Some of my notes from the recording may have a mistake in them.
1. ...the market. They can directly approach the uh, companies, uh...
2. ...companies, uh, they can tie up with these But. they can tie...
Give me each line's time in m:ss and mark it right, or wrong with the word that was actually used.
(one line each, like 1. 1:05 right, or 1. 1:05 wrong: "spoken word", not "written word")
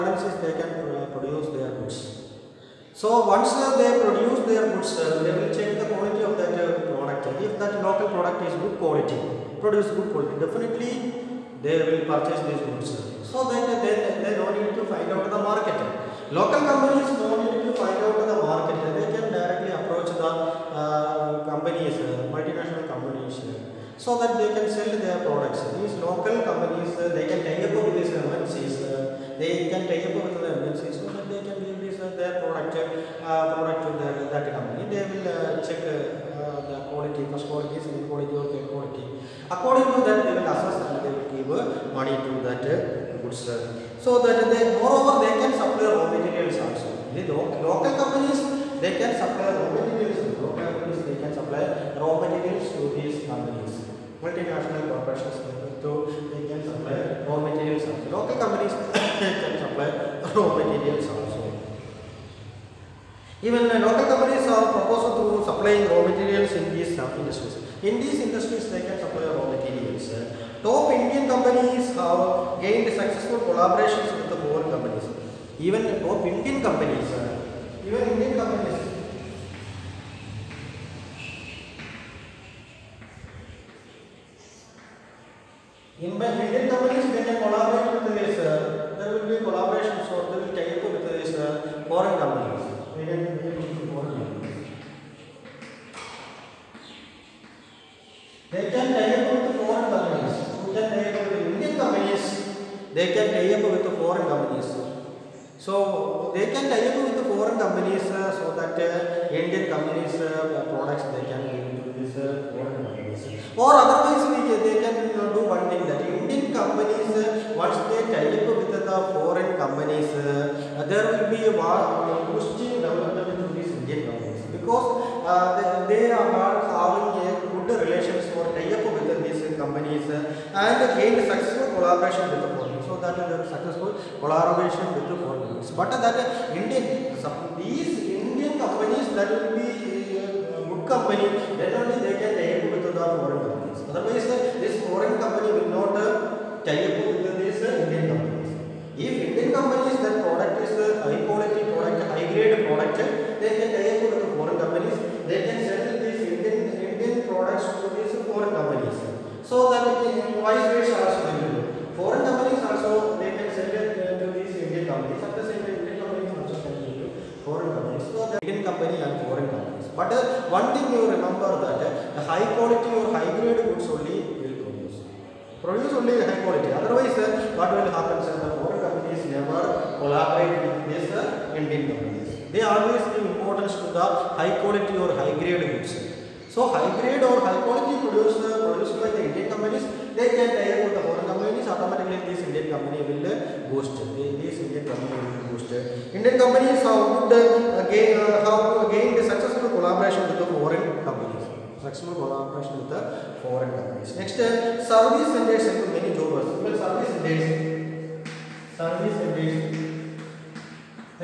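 1. 0:18 right
2. 0:26 wrong: "MNCs", not "But".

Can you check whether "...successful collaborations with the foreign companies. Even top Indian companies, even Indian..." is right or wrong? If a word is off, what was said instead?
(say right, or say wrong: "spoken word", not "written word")
right.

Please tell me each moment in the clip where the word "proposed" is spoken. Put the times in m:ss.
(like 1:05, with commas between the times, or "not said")
1:04.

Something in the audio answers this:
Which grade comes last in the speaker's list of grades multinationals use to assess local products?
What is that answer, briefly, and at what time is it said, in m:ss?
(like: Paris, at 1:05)
Third quality, at 0:38.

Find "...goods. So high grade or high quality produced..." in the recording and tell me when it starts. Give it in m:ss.
3:05.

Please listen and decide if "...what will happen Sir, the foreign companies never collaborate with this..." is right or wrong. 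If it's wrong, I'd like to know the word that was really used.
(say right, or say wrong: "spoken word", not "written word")
right.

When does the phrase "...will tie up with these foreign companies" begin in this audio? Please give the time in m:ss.
1:30.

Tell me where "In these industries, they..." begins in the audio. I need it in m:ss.
1:07.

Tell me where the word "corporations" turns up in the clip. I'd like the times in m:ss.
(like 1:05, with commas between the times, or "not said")
0:54.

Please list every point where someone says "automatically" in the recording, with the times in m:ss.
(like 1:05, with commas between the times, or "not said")
3:11.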